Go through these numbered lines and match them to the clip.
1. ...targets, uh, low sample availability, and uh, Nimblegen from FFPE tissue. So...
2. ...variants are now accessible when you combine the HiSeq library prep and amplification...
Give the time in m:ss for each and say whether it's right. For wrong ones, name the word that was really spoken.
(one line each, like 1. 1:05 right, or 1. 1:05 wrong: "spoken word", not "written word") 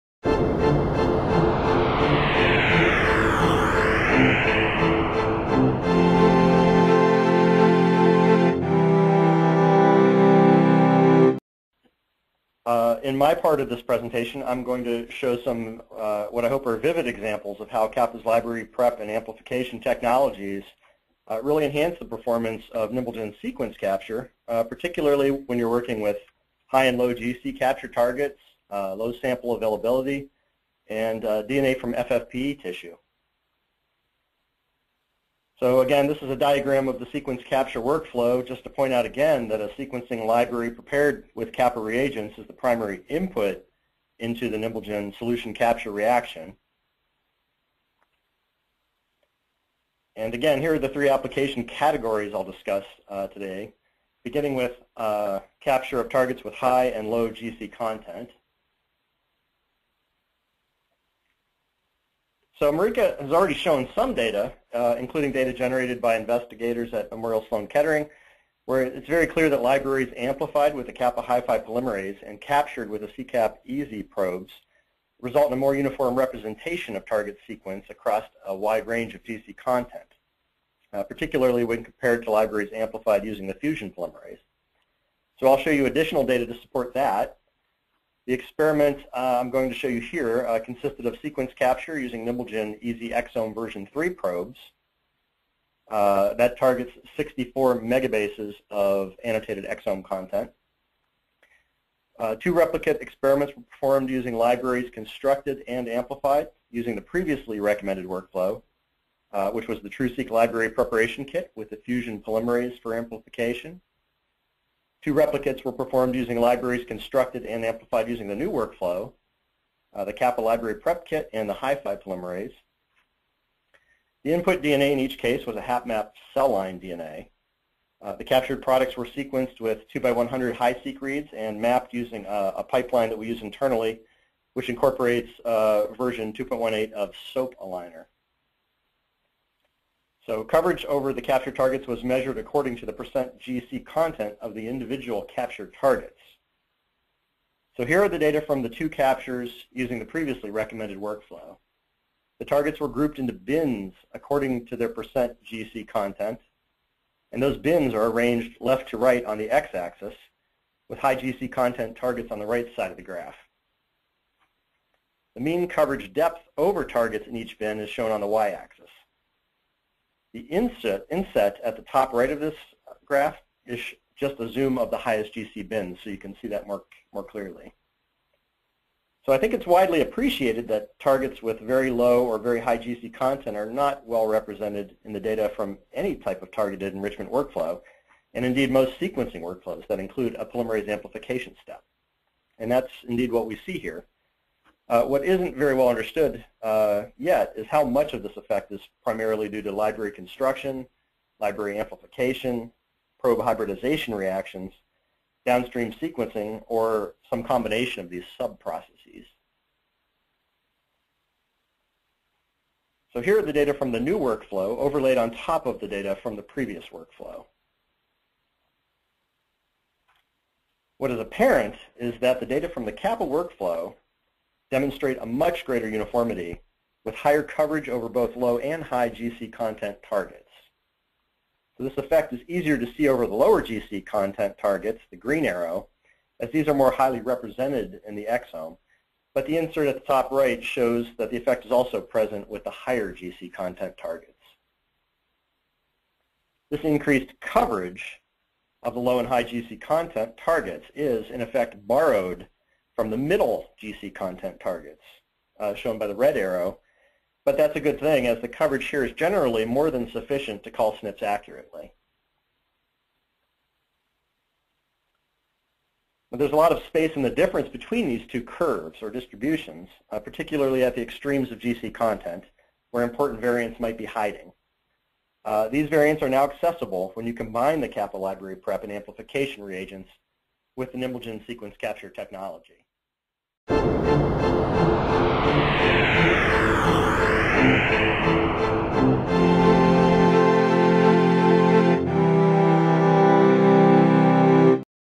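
1. 0:27 wrong: "DNA", not "Nimblegen"
2. 4:35 wrong: "Kapa", not "HiSeq".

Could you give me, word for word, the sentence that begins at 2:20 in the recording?
So coverage over the capture targets was measured according to the percent GC content of the individual capture targets.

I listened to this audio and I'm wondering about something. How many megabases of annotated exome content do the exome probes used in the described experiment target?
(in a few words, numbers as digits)
64.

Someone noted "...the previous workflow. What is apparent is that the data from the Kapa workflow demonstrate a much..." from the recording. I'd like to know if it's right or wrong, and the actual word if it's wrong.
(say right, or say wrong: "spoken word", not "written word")
right.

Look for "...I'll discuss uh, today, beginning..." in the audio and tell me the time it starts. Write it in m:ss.
0:52.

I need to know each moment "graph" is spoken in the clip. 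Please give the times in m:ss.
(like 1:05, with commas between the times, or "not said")
2:43, 2:53.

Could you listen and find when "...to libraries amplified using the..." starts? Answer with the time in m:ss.
1:22.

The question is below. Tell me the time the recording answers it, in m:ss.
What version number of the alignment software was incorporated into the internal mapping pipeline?
2:16.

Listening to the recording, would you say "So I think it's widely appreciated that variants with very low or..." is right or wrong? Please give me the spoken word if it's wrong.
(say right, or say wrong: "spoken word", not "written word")
wrong: "targets", not "variants".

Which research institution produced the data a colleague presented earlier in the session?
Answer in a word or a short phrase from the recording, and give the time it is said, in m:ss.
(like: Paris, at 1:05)
Memorial Sloan Kettering, at 1:07.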